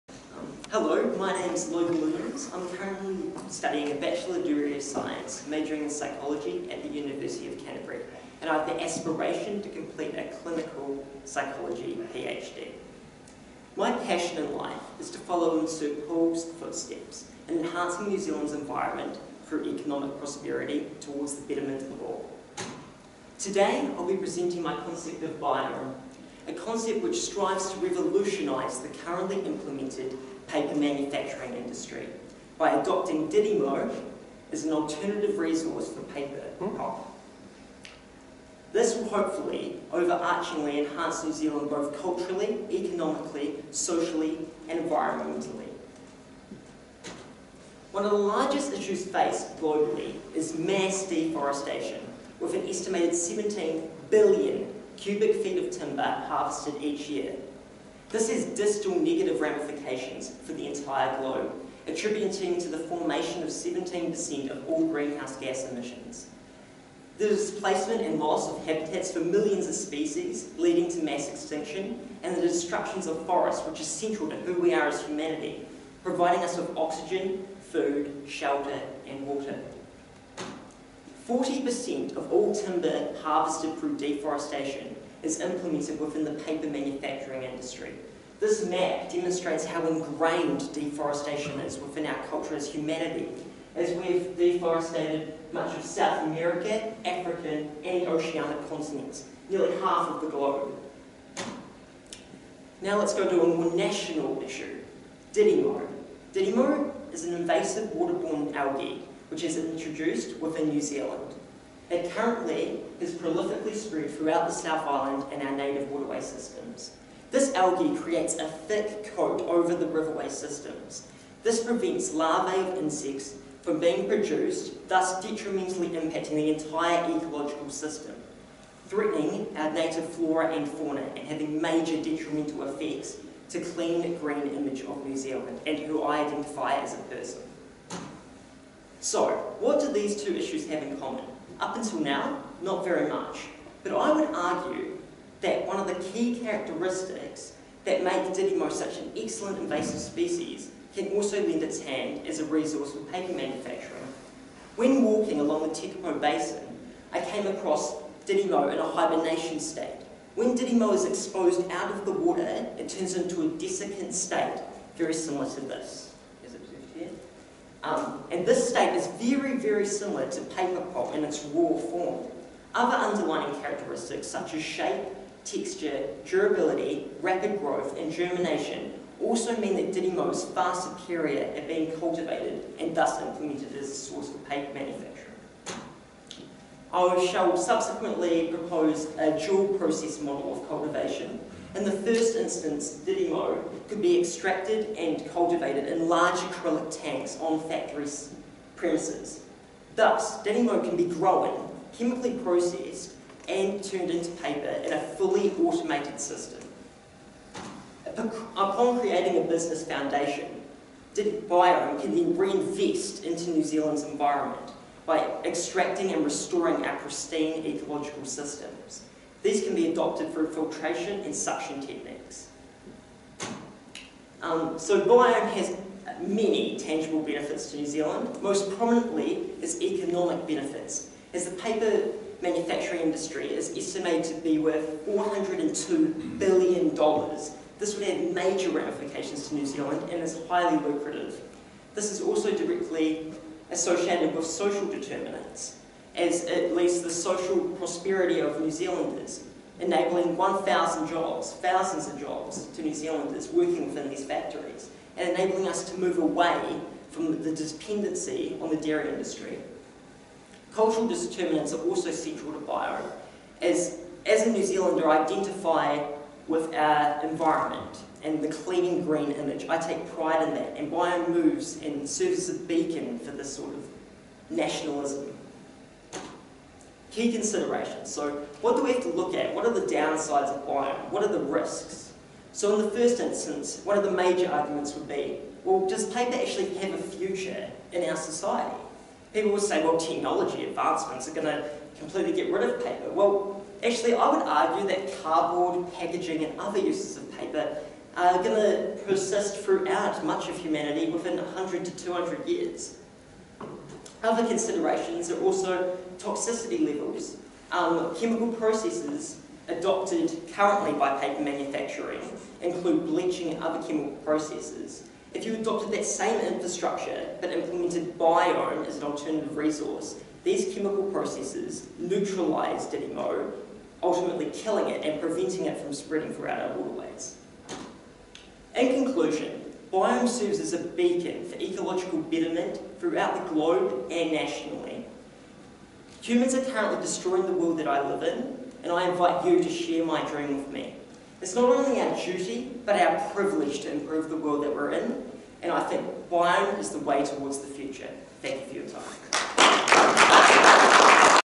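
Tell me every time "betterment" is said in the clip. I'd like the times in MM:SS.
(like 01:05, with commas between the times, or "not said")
00:21, 05:32.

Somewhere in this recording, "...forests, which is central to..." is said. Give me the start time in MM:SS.
01:13.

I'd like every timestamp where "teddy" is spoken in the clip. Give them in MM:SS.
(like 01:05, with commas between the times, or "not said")
not said.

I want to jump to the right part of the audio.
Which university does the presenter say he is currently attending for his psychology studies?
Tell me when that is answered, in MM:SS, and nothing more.
00:06.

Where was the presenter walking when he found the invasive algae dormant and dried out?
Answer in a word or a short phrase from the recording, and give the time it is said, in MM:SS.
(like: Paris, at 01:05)
Tekapo Basin, at 02:35.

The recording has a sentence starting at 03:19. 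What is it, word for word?
Thus, Didymo can be grown, chemically processed, and turned into paper in a fully automated system.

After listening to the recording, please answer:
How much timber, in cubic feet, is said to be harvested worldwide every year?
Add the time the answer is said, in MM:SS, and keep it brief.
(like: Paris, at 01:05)
17 billion cubic feet, at 00:53.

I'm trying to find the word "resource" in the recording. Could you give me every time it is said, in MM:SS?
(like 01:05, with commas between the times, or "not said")
00:35, 02:32, 05:19.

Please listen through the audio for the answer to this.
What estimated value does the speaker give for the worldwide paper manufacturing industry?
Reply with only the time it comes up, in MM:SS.
03:55.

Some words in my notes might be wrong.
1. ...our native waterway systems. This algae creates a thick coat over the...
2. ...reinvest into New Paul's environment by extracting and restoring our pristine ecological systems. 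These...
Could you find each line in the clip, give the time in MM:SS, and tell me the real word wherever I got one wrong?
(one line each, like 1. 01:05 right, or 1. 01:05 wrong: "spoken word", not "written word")
1. 01:55 right
2. 03:32 wrong: "Zealand", not "Paul".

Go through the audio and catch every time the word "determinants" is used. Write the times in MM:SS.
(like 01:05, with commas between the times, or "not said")
04:04, 04:21.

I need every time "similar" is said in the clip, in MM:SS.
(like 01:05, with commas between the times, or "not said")
02:45, 02:49.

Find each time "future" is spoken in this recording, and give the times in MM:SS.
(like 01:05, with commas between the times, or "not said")
04:47, 05:47.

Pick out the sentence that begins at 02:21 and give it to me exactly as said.
Up until now, not very much.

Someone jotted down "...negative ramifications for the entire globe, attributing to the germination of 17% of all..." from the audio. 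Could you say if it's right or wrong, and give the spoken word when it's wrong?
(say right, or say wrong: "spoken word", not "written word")
wrong: "formation", not "germination".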